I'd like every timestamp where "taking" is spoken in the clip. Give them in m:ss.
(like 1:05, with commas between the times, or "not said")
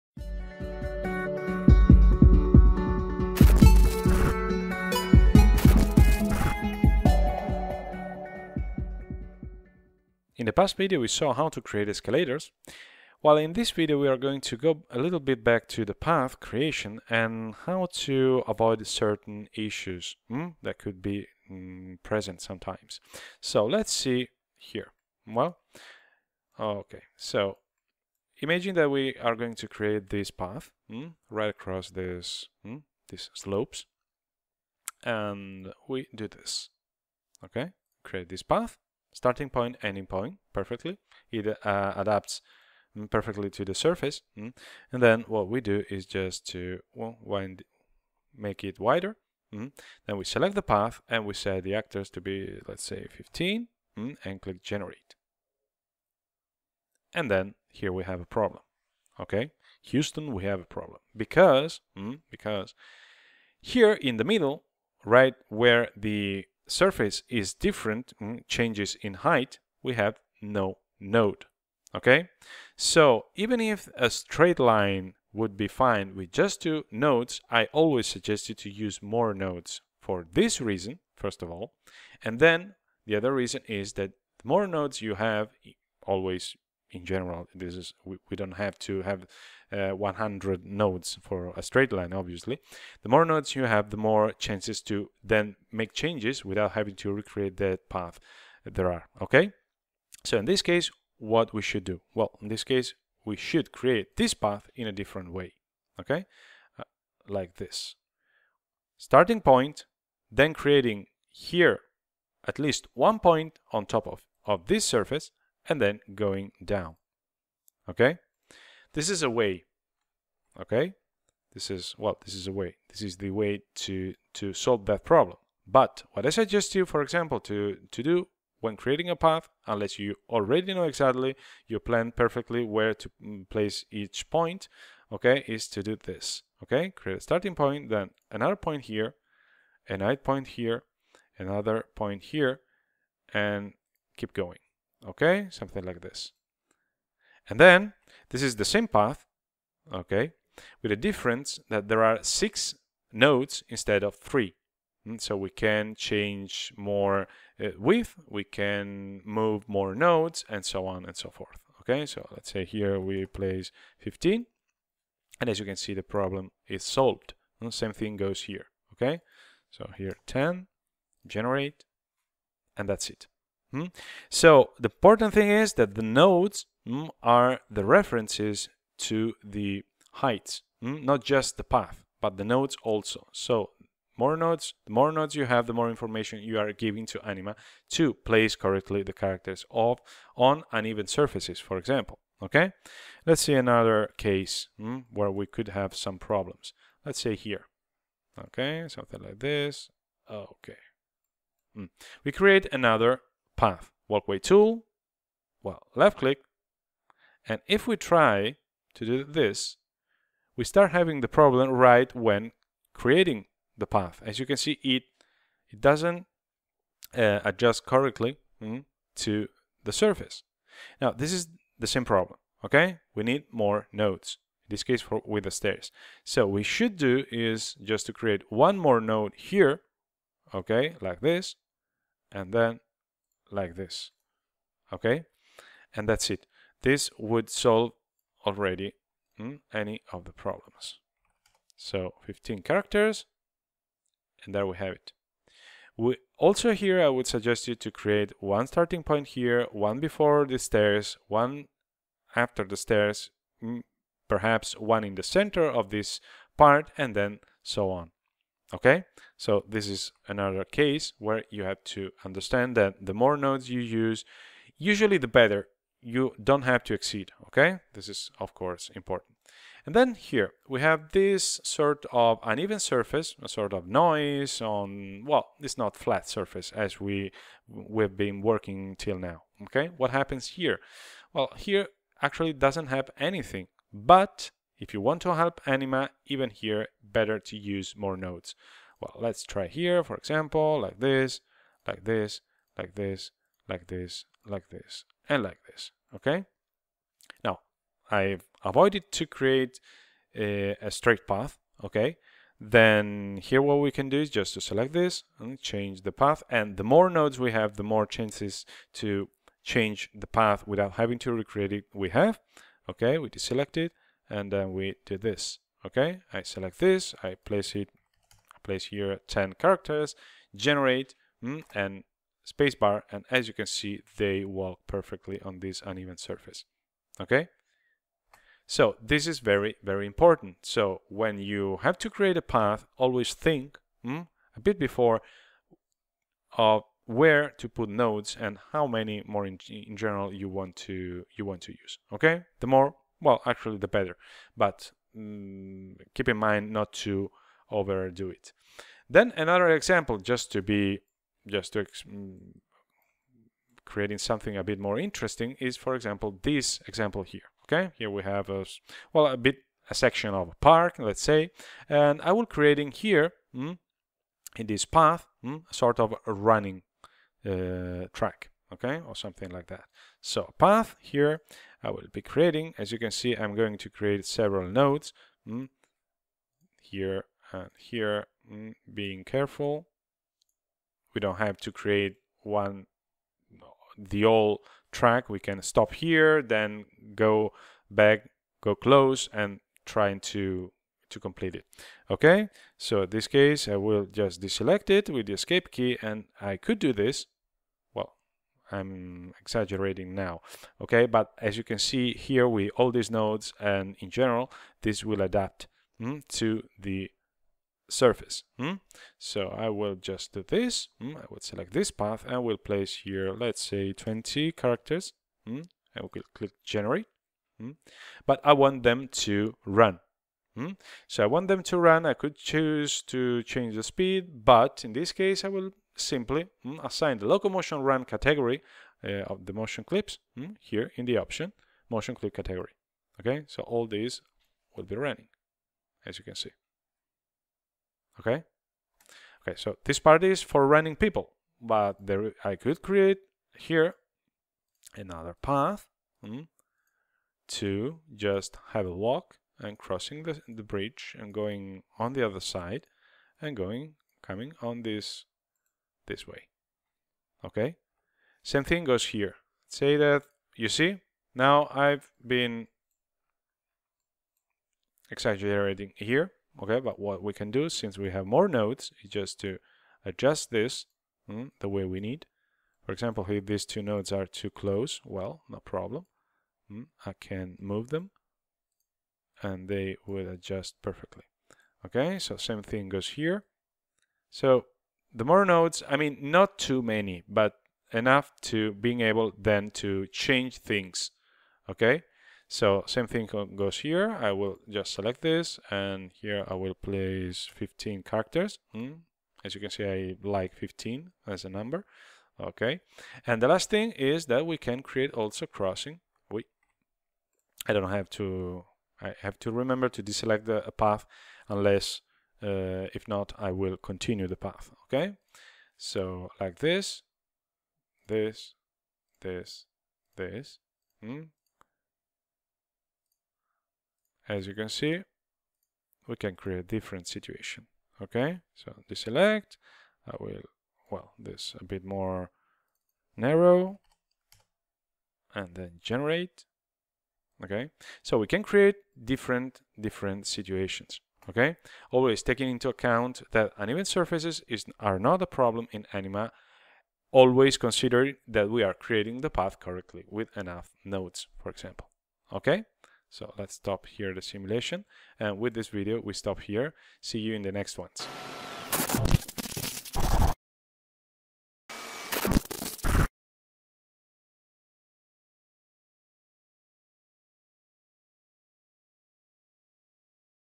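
9:02.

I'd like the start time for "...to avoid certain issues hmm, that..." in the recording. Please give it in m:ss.
0:18.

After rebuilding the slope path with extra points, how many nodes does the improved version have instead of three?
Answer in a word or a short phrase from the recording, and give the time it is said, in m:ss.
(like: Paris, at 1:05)
6, at 2:32.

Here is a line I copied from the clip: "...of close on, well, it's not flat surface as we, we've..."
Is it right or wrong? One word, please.
wrong.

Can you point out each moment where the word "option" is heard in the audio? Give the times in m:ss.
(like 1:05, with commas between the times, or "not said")
7:11.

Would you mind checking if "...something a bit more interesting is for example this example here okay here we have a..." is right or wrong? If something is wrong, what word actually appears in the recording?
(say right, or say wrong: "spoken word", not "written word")
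right.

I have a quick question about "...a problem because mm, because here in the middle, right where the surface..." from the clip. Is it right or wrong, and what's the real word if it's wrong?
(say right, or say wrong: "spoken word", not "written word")
right.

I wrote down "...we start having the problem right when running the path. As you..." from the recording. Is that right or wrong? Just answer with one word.
wrong.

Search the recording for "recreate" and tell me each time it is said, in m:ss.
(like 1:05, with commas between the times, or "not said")
1:37, 5:11.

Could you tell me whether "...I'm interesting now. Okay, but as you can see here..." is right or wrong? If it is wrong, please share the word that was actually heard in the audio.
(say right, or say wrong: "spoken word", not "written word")
wrong: "exaggerating", not "interesting".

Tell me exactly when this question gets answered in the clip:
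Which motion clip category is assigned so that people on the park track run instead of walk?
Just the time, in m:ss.
7:07.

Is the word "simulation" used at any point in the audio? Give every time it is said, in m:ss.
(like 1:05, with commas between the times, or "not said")
9:14.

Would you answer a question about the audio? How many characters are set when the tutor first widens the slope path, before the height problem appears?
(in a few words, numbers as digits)
15.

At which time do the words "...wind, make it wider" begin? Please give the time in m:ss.
0:47.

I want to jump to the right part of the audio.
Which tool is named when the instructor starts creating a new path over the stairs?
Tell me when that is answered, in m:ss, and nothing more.
3:24.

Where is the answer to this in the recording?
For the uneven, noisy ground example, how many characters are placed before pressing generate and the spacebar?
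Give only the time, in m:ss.
5:18.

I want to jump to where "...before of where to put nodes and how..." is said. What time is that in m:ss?
5:34.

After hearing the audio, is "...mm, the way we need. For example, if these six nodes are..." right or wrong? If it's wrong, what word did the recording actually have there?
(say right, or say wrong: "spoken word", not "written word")
wrong: "two", not "six".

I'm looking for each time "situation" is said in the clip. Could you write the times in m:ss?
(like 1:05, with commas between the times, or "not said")
8:47, 9:00.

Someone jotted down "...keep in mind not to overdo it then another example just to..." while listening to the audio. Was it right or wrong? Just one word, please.
right.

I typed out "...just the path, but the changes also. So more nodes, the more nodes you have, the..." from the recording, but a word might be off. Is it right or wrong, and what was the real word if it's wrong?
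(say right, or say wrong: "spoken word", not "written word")
wrong: "nodes", not "changes".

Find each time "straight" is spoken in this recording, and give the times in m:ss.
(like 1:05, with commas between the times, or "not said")
1:14, 1:31, 5:00.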